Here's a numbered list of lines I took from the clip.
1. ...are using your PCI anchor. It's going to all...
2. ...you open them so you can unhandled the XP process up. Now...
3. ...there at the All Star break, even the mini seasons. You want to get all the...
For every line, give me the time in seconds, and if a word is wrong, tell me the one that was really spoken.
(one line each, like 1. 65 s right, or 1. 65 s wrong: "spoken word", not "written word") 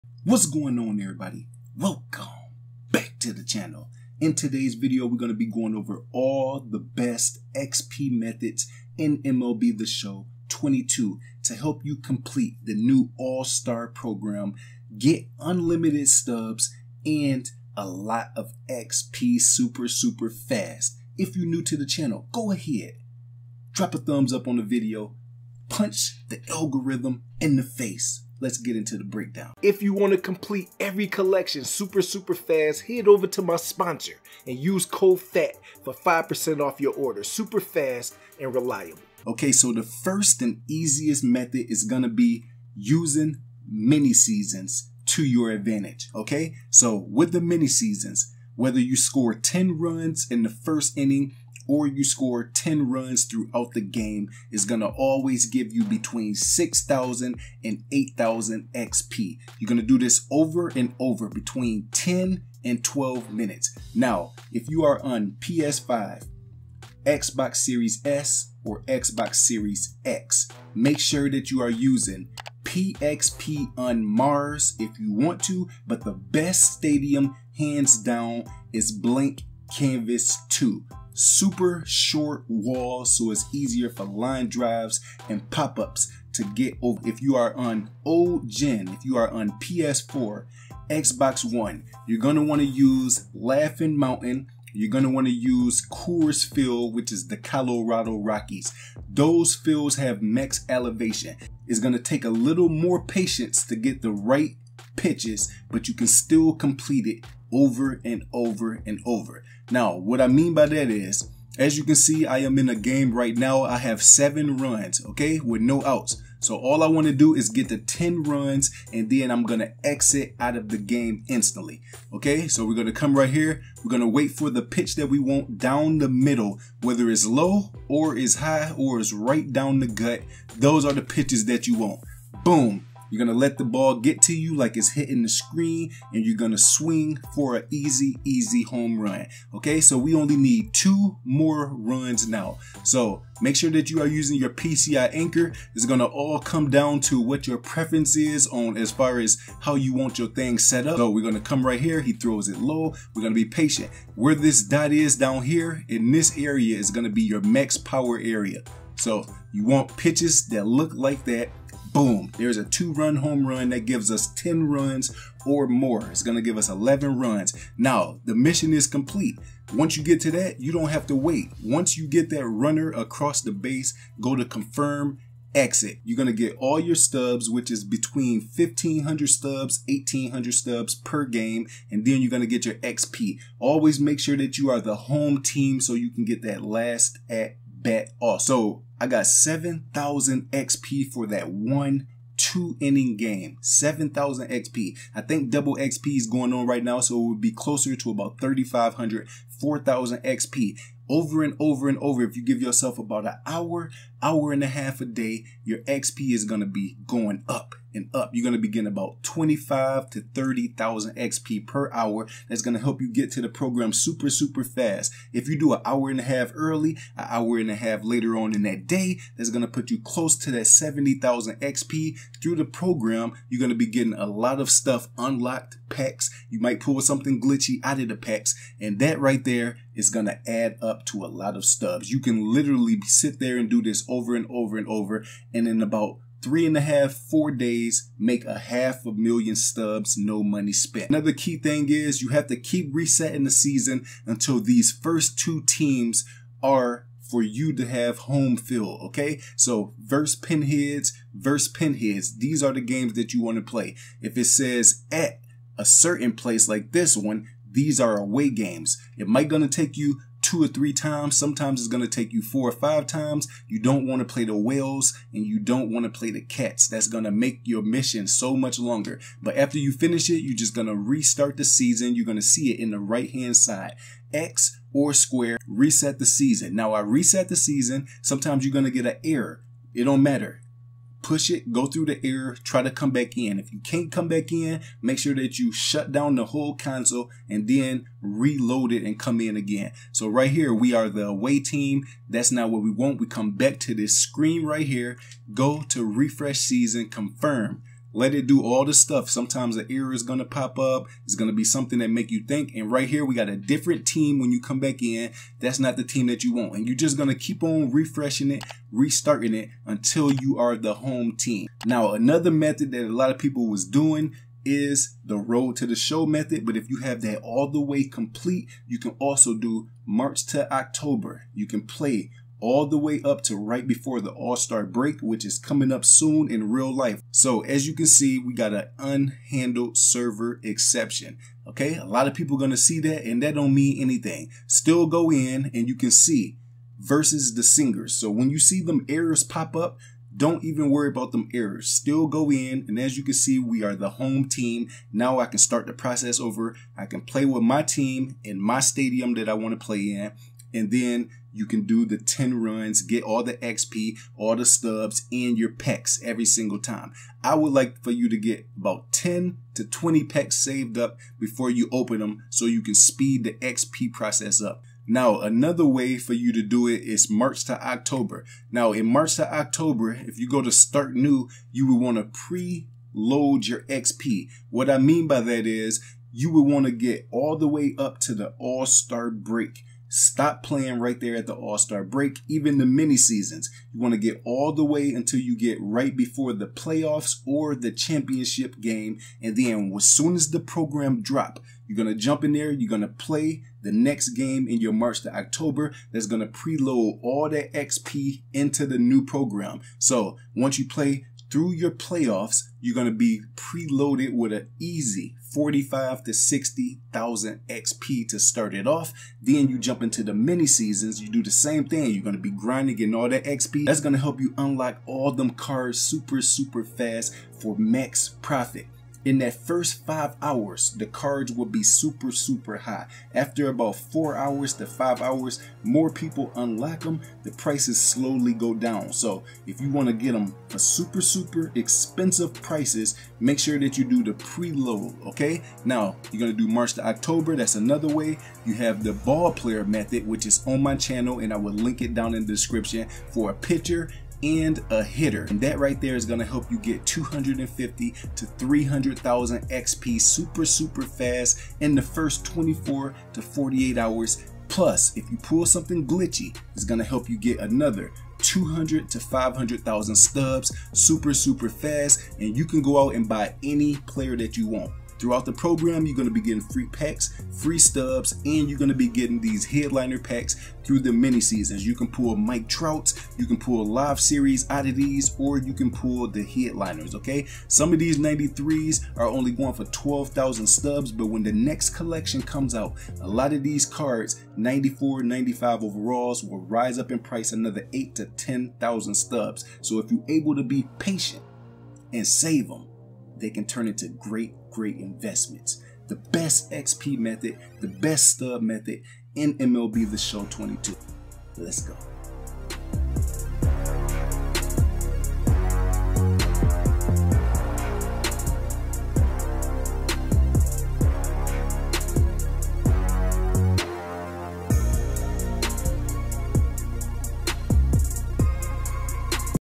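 1. 144 s right
2. 361 s wrong: "speed", not "unhandled"
3. 381 s right.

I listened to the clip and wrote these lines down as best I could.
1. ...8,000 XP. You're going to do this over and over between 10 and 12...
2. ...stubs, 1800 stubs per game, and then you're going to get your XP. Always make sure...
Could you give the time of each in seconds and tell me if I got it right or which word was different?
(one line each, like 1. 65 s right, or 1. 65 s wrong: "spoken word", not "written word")
1. 57 s right
2. 179 s right.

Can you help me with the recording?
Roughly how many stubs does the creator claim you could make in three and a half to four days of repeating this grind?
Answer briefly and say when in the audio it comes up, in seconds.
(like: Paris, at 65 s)
half a million stubs, at 238 s.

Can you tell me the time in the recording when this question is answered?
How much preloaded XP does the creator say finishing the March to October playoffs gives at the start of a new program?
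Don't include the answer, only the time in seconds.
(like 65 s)
405 s.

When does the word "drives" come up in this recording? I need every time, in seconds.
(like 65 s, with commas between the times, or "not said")
84 s.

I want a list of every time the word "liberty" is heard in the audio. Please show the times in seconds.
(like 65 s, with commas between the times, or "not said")
not said.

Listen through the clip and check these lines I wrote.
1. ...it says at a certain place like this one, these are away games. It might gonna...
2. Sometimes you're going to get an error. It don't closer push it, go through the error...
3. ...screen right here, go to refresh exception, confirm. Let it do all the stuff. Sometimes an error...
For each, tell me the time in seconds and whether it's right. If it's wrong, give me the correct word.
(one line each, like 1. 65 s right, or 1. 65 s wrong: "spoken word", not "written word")
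1. 254 s right
2. 278 s wrong: "matter", not "closer"
3. 294 s wrong: "season", not "exception".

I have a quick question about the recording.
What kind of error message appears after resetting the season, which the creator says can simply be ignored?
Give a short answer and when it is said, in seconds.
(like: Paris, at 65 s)
unhandled server exception, at 329 s.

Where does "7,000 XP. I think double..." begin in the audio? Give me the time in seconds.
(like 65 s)
193 s.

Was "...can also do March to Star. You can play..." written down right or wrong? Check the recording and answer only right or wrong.
wrong.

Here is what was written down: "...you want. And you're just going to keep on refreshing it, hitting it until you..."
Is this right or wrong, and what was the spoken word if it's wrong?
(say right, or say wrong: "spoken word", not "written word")
wrong: "restarting", not "hitting".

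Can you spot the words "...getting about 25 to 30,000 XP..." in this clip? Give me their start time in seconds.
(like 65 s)
208 s.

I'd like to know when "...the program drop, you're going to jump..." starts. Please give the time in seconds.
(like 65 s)
390 s.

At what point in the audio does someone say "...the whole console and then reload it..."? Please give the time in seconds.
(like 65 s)
286 s.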